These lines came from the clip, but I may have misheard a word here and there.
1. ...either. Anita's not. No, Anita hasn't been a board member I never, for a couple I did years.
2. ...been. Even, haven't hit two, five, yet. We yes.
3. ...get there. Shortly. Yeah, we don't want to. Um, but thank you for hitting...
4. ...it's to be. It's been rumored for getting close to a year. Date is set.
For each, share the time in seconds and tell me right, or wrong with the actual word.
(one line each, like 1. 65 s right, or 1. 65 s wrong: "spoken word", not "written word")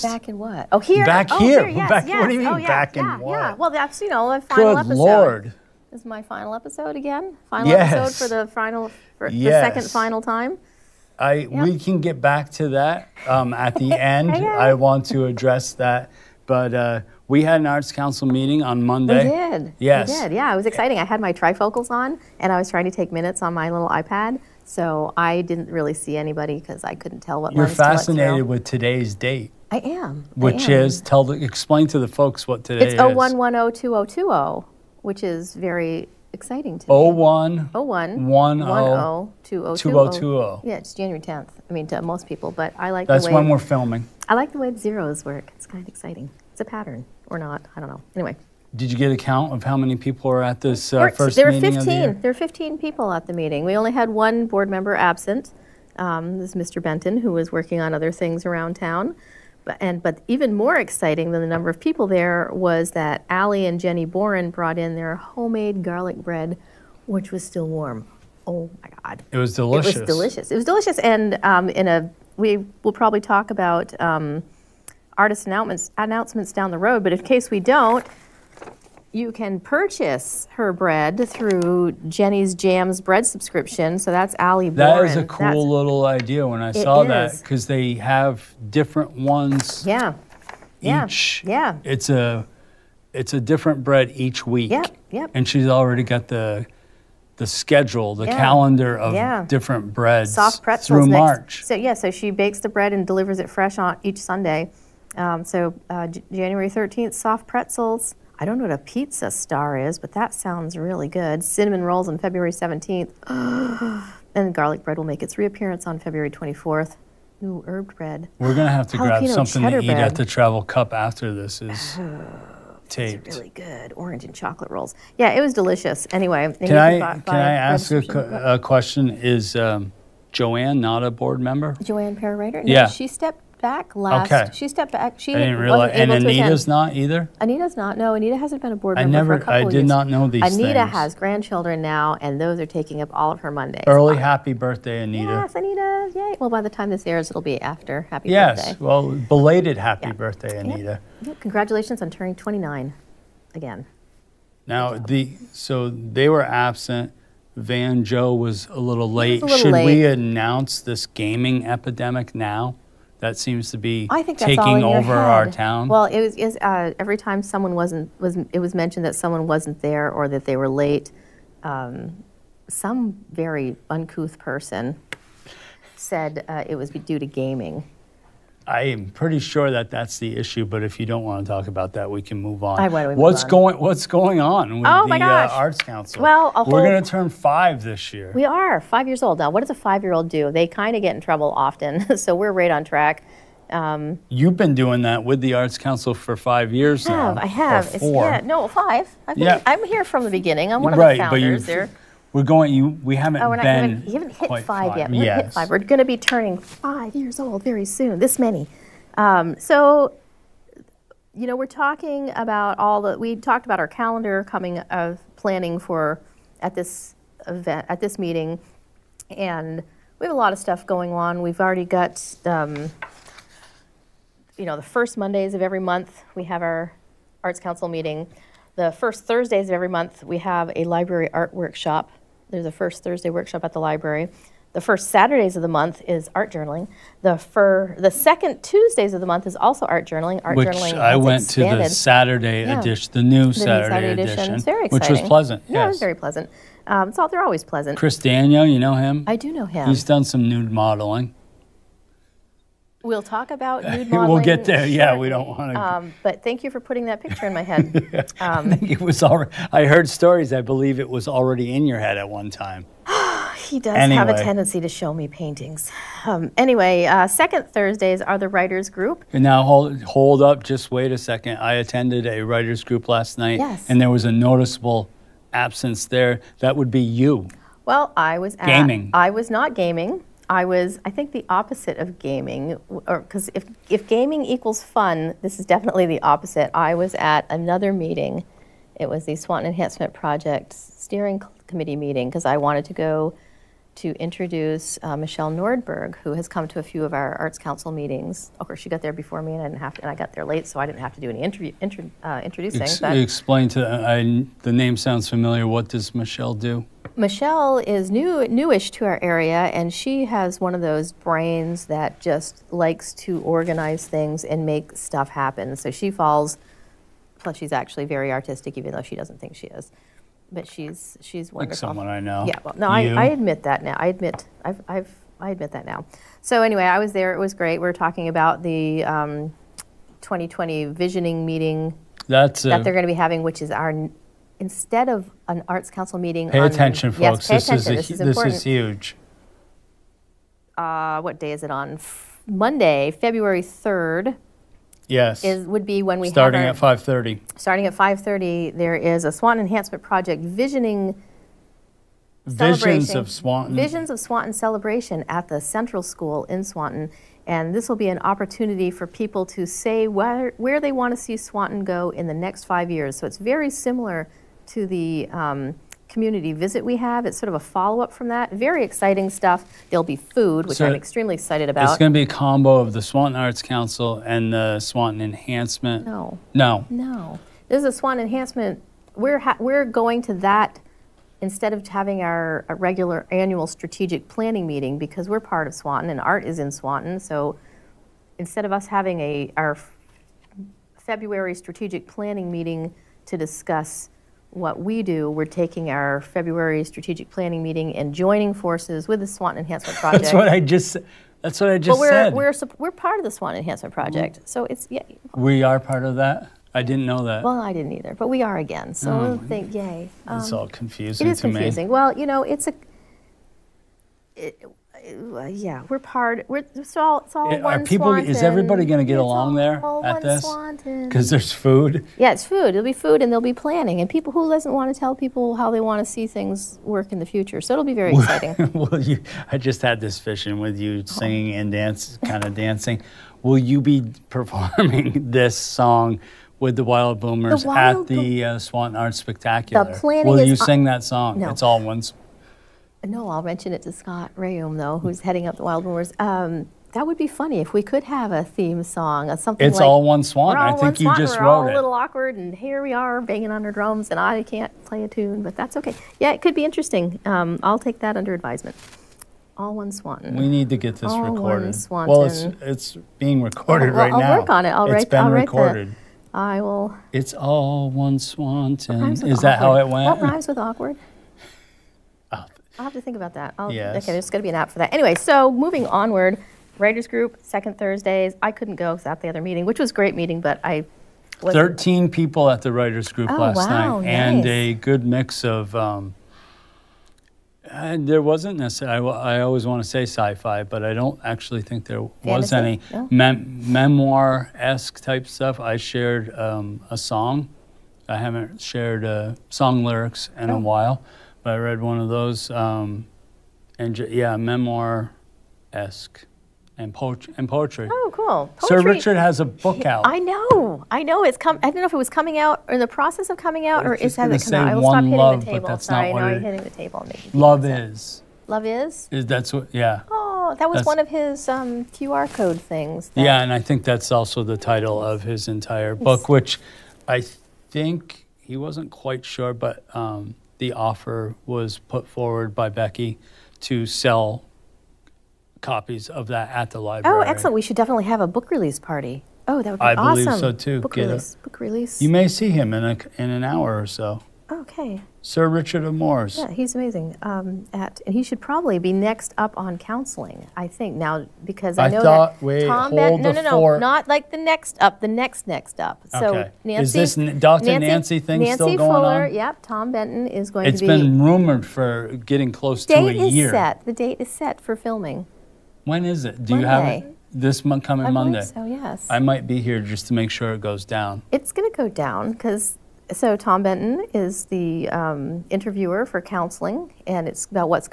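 1. 136 s right
2. 203 s wrong: "five", not "two"
3. 254 s wrong: "putting", not "hitting"
4. 560 s right.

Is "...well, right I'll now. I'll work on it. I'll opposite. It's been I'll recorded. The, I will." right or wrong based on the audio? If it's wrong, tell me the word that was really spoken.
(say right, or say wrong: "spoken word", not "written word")
wrong: "write", not "opposite".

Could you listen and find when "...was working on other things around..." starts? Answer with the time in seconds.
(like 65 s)
57 s.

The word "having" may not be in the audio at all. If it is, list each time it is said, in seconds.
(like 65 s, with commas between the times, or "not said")
333 s, 381 s, 388 s.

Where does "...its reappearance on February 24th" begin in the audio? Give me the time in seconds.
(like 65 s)
115 s.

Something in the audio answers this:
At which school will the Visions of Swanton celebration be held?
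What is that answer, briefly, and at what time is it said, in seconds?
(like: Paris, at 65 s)
Central School, at 355 s.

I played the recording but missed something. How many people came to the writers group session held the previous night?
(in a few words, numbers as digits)
13.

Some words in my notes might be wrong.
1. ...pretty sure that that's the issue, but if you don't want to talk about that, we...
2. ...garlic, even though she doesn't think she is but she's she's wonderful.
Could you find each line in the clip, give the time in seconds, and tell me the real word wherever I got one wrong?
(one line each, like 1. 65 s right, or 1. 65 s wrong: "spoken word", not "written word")
1. 179 s right
2. 318 s wrong: "artistic", not "garlic".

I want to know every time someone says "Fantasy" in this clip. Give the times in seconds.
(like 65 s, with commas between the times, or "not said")
492 s.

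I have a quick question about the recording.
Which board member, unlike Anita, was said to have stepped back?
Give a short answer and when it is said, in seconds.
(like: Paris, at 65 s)
Joanne Perrier, at 131 s.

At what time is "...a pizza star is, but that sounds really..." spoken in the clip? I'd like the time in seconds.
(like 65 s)
108 s.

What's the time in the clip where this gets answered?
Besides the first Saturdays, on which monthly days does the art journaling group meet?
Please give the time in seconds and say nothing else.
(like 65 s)
238 s.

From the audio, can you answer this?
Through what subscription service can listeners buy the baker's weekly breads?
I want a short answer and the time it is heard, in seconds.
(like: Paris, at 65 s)
Jenny's Jams, at 82 s.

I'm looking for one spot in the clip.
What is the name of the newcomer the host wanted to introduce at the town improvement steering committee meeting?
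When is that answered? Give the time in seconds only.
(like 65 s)
295 s.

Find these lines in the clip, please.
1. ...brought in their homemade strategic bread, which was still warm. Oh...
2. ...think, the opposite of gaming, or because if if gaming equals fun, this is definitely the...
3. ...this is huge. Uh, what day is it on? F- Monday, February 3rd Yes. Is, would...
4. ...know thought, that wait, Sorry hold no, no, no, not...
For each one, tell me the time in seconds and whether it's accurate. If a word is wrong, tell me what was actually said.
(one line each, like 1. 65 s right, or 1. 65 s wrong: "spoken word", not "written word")
1. 64 s wrong: "garlic", not "strategic"
2. 281 s right
3. 338 s right
4. 551 s wrong: "Tom", not "Sorry".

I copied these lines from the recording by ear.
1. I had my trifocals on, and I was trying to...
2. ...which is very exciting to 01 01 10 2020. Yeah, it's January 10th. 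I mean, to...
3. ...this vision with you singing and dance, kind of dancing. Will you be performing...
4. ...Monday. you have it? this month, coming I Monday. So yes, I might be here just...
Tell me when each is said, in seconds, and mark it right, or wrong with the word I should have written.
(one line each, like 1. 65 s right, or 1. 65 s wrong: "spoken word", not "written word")
1. 20 s right
2. 35 s right
3. 430 s right
4. 566 s right.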